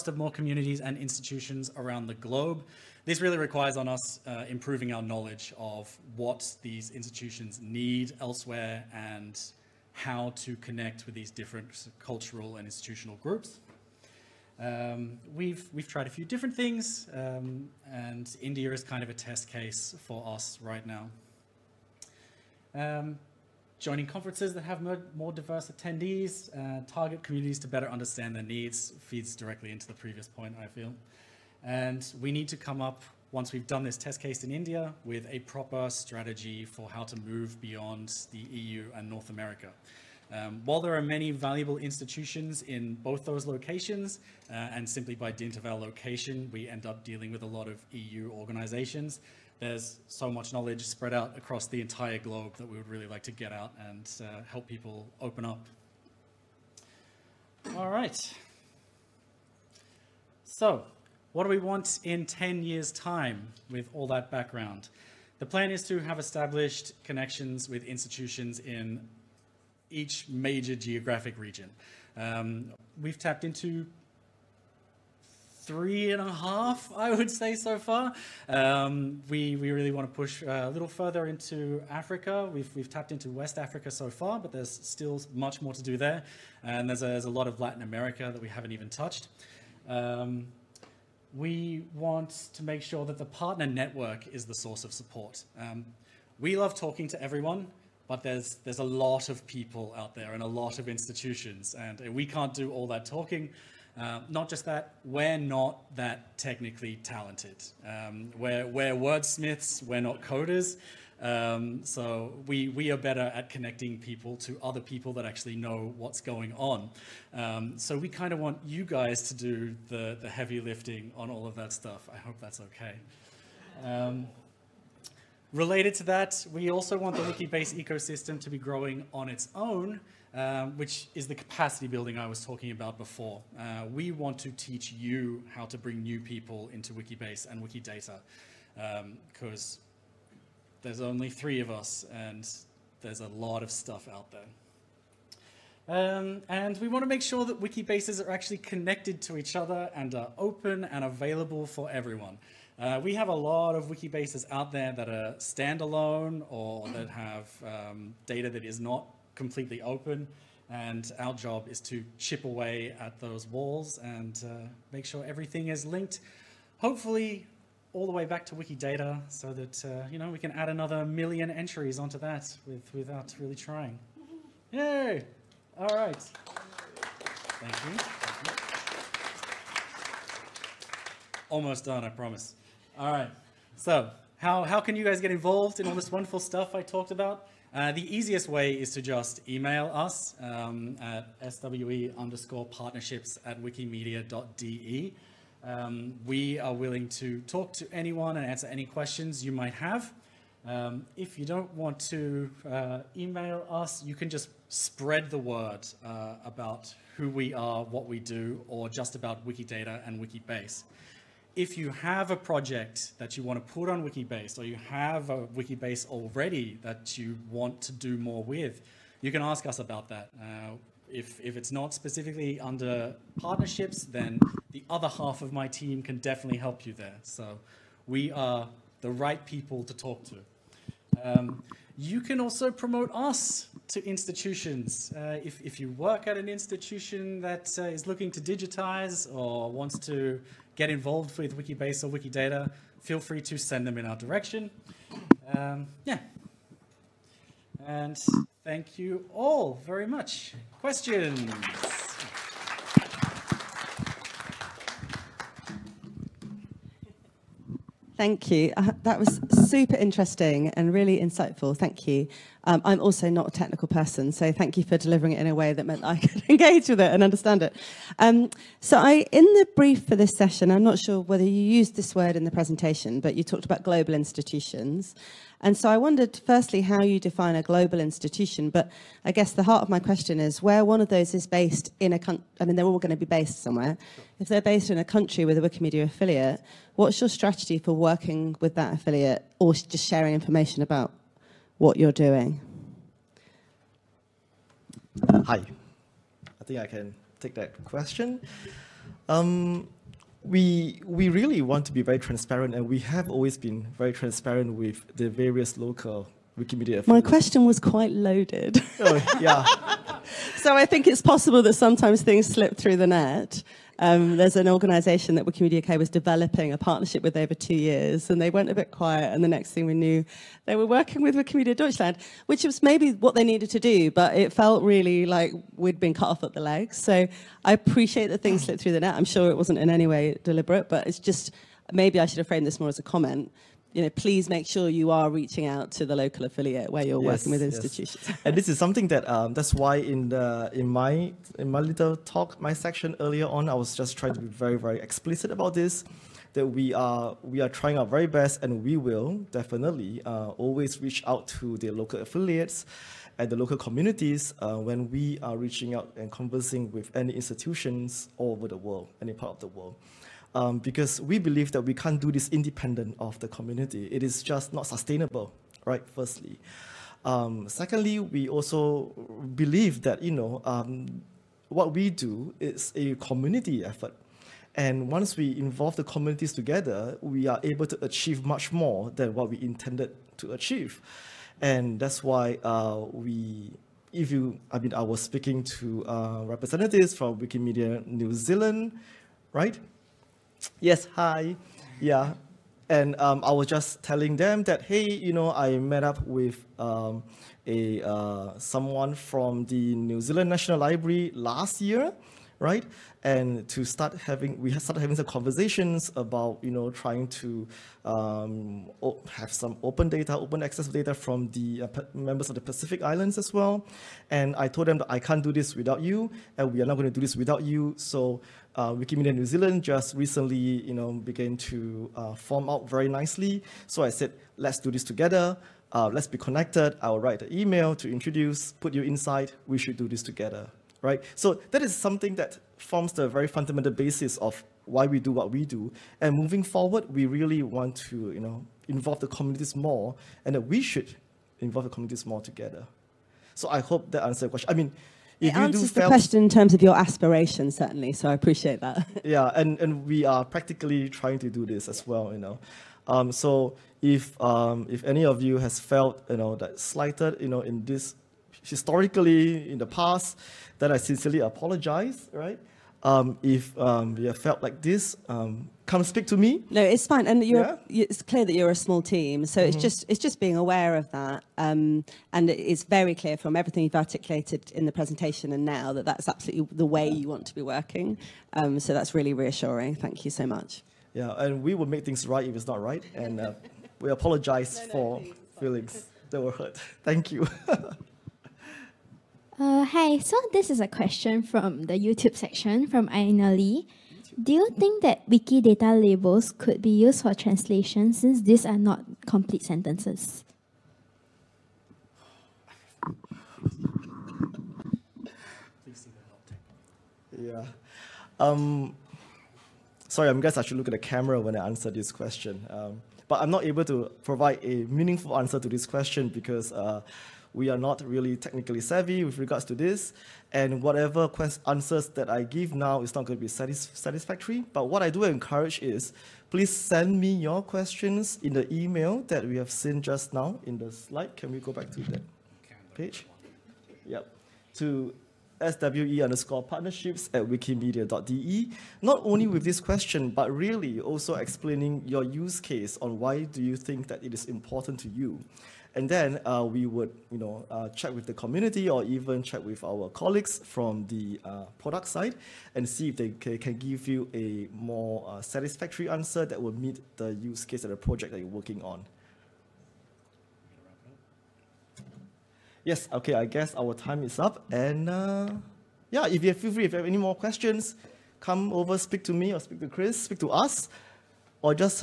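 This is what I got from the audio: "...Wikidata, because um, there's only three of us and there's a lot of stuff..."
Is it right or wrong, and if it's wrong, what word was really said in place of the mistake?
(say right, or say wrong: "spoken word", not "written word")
right.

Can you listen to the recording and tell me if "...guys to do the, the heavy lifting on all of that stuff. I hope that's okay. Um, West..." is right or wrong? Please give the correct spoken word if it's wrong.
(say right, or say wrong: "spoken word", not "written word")
wrong: "Related", not "West".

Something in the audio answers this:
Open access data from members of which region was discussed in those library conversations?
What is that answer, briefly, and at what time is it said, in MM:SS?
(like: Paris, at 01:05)
Pacific Islands, at 06:52.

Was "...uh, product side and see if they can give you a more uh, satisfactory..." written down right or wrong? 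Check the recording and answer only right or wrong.
right.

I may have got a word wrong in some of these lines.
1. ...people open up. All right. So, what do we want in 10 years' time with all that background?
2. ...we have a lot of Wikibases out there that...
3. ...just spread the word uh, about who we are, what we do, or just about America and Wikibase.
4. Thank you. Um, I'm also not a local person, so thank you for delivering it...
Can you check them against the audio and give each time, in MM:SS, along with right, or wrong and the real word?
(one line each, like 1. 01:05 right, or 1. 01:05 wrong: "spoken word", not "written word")
1. 00:54 right
2. 02:33 right
3. 03:24 wrong: "Wikidata", not "America"
4. 04:21 wrong: "technical", not "local".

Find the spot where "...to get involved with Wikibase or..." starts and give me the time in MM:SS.
04:00.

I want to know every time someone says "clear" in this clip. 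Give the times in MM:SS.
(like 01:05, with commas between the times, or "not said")
07:48, 07:53.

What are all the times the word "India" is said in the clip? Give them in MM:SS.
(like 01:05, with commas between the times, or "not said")
00:18, 00:34.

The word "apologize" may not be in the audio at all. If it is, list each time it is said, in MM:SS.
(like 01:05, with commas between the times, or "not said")
07:41, 08:04.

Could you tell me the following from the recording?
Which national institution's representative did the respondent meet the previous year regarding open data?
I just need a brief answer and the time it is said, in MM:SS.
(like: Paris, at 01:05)
New Zealand National Library, at 06:39.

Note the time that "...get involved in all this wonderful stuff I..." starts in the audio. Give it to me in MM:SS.
03:05.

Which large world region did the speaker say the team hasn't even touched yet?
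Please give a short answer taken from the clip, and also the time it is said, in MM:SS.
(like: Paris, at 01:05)
Latin America, at 01:27.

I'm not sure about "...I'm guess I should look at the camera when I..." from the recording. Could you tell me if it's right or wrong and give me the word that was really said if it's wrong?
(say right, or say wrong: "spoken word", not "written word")
right.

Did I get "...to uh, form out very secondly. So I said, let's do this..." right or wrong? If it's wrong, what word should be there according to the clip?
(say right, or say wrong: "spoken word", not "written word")
wrong: "nicely", not "secondly".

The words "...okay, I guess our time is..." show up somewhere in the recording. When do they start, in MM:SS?
09:23.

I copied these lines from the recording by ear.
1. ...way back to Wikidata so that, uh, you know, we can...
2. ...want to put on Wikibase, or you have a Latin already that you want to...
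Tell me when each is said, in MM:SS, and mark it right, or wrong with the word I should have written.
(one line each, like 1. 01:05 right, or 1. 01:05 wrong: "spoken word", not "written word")
1. 02:48 right
2. 03:33 wrong: "Wikibase", not "Latin".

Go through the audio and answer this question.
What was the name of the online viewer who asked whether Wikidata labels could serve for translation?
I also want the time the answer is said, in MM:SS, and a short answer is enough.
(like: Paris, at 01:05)
Aina Lee, at 08:13.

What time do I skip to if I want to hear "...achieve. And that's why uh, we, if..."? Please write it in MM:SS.
06:20.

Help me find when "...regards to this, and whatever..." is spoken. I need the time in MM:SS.
08:39.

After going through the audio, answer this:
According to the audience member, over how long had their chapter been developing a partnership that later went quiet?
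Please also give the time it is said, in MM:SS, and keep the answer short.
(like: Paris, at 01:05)
2 years, at 05:17.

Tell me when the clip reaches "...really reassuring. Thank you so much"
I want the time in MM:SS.
07:59.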